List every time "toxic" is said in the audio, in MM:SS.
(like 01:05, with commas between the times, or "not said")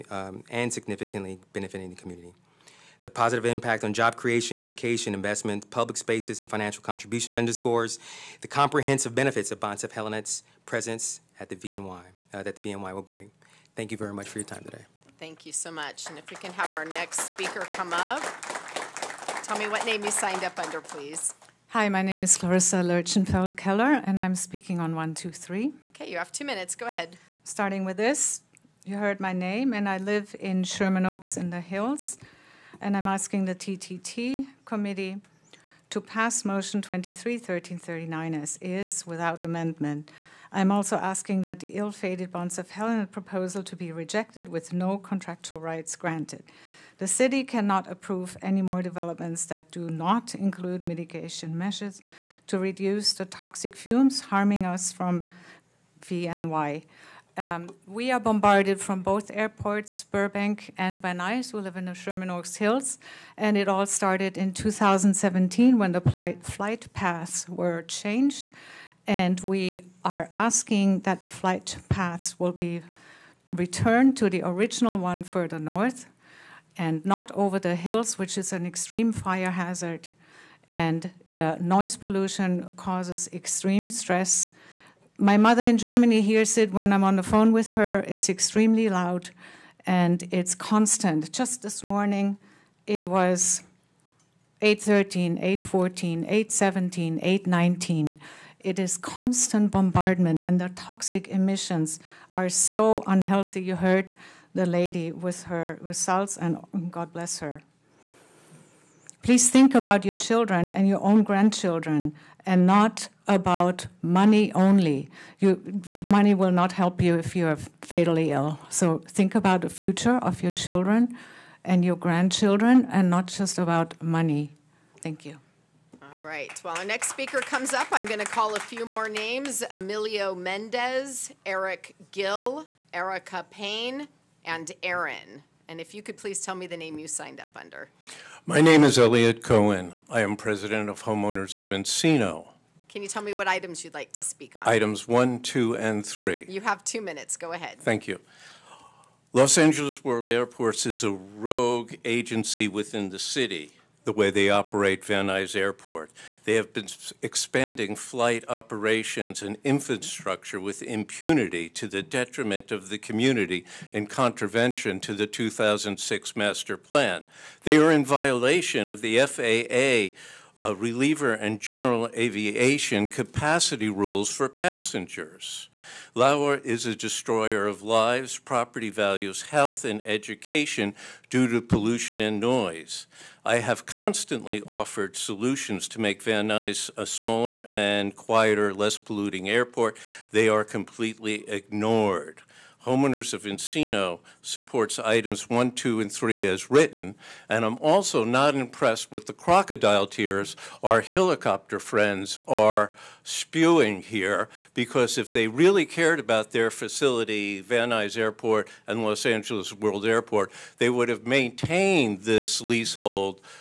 00:53, 01:40.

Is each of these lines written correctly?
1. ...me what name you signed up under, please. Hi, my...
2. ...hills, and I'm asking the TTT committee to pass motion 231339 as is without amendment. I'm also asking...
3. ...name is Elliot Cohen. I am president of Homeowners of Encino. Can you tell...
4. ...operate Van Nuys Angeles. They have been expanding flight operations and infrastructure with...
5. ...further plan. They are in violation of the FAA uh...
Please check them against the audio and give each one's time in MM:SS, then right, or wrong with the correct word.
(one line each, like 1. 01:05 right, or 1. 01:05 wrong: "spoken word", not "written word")
1. 00:19 right
2. 00:31 right
3. 02:18 right
4. 02:34 wrong: "Airport", not "Angeles"
5. 02:46 wrong: "master", not "further".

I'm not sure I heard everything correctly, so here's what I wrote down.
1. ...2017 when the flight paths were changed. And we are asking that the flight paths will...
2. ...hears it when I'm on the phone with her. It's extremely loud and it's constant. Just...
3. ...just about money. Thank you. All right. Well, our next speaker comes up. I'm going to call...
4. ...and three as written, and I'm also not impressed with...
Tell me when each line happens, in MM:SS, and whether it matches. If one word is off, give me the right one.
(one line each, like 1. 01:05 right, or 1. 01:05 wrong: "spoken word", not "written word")
1. 01:04 right
2. 01:26 right
3. 02:03 right
4. 03:15 right.